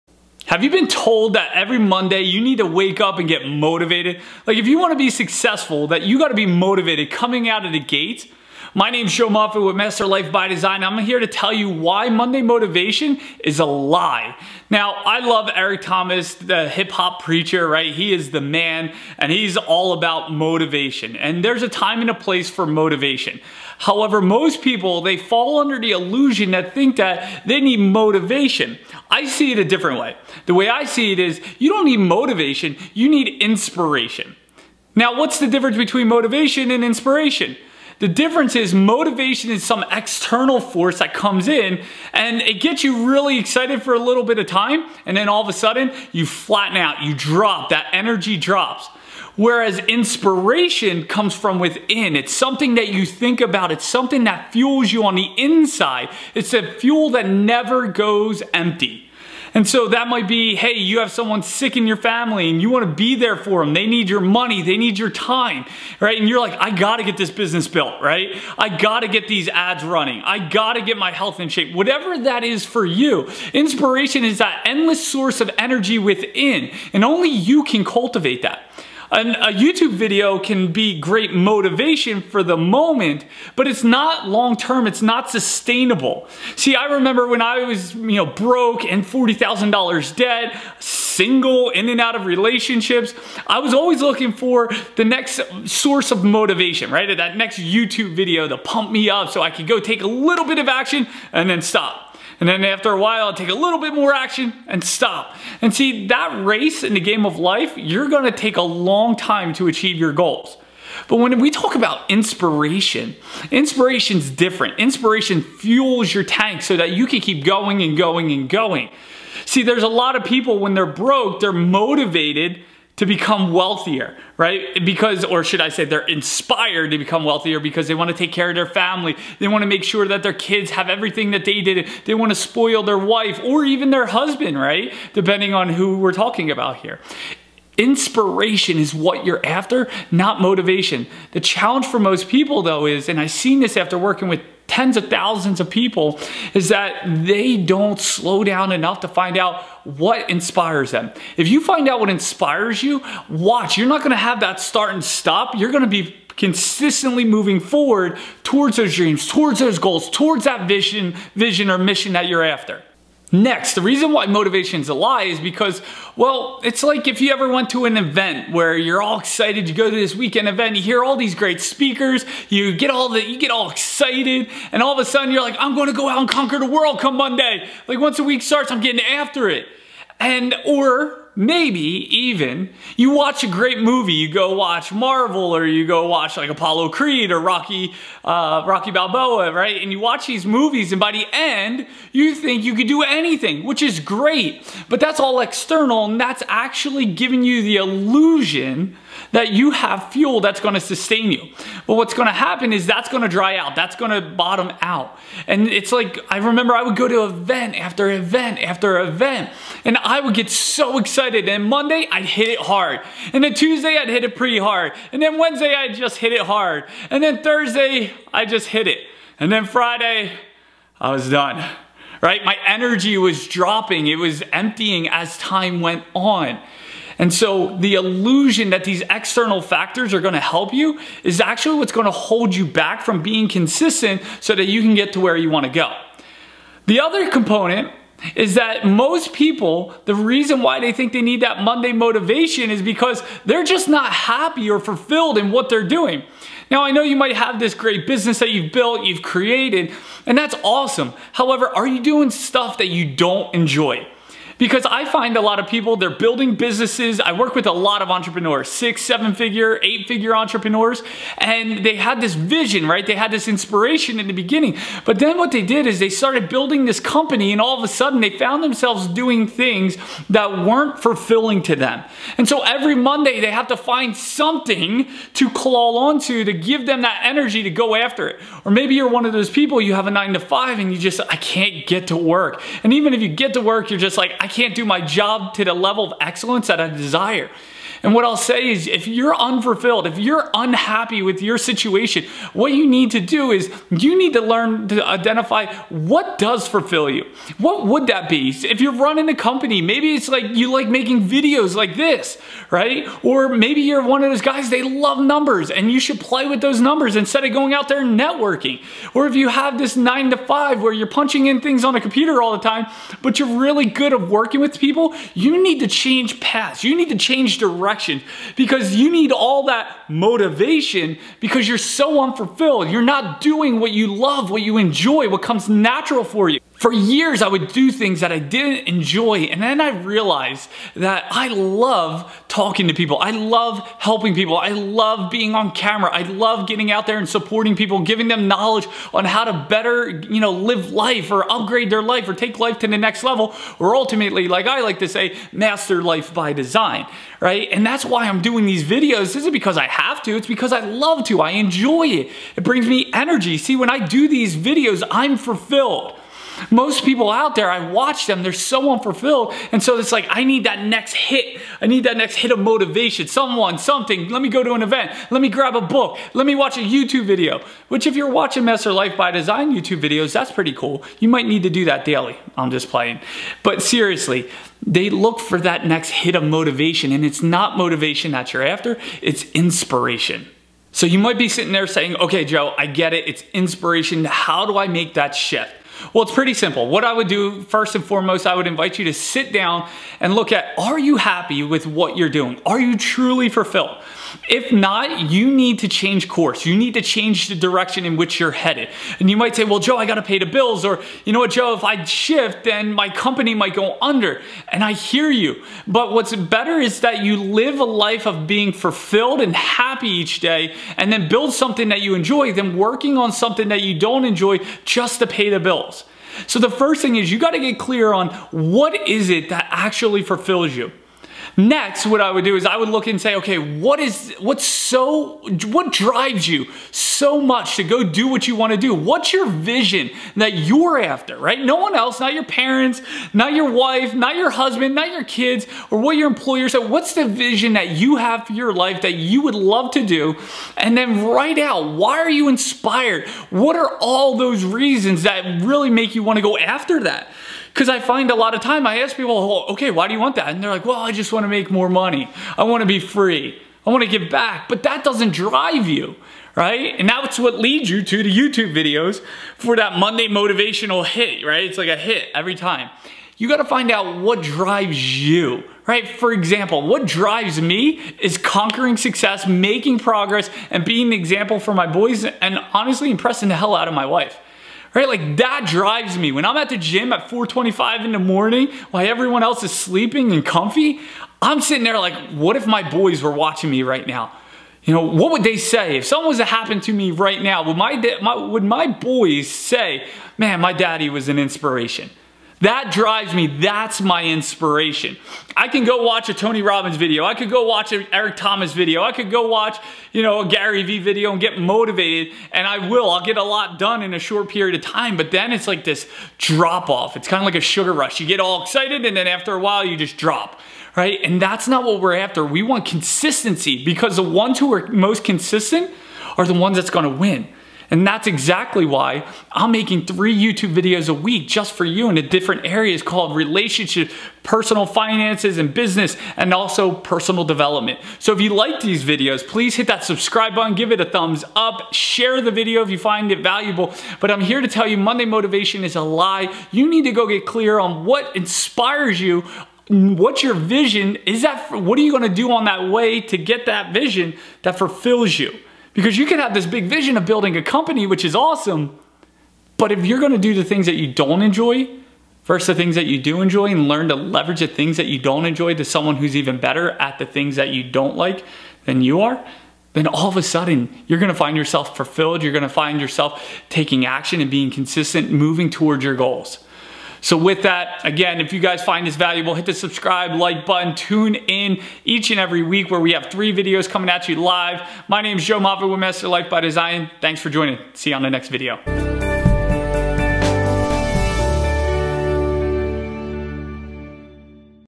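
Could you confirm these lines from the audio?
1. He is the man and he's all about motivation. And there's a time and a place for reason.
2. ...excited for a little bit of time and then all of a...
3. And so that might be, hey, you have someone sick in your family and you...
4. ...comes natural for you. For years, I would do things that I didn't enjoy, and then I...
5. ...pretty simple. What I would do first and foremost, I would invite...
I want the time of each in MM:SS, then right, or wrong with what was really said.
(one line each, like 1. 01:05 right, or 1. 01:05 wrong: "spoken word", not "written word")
1. 00:17 wrong: "motivation", not "reason"
2. 00:43 right
3. 00:59 right
4. 05:25 right
5. 06:26 right.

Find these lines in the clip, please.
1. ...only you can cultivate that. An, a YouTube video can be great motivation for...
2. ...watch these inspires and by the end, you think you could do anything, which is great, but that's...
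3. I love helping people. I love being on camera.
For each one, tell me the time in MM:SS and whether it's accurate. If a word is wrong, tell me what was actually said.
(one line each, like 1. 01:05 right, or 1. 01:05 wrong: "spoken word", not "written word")
1. 01:17 right
2. 03:09 wrong: "movies", not "inspires"
3. 05:33 right.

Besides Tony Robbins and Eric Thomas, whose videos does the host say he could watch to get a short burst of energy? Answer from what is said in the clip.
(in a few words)
Gary Vee.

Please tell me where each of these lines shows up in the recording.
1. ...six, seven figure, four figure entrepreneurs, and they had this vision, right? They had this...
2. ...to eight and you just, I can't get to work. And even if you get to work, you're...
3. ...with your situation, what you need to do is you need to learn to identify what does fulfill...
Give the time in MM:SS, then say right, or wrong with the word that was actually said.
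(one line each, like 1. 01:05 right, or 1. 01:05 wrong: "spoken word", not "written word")
1. 04:18 wrong: "eight", not "four"
2. 04:40 wrong: "five", not "eight"
3. 04:51 right.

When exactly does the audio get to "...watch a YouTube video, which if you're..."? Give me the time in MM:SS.
06:06.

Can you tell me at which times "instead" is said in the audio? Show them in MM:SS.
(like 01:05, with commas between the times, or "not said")
05:07.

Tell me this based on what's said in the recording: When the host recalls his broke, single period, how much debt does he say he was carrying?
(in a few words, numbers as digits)
$40,000.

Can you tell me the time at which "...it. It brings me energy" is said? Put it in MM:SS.
05:52.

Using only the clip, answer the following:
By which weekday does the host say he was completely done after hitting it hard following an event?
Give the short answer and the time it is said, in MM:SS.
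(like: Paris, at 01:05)
Friday, at 03:39.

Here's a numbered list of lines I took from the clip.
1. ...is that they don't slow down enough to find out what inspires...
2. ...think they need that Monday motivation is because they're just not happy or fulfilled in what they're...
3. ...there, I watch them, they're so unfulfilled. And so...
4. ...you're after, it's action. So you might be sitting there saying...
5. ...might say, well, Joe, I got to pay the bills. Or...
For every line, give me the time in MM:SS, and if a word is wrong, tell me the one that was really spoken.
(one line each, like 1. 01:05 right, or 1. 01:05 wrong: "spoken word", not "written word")
1. 02:26 right
2. 04:00 right
3. 05:57 right
4. 06:18 wrong: "inspiration", not "action"
5. 06:39 right.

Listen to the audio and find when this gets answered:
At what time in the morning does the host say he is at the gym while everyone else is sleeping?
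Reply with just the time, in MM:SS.
07:57.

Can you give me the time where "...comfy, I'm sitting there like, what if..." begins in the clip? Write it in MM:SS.
08:00.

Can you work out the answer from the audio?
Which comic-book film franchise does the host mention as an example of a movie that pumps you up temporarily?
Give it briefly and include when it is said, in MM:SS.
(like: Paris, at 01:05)
Marvel, at 03:04.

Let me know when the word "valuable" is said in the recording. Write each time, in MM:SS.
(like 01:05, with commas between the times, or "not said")
08:53, 09:29.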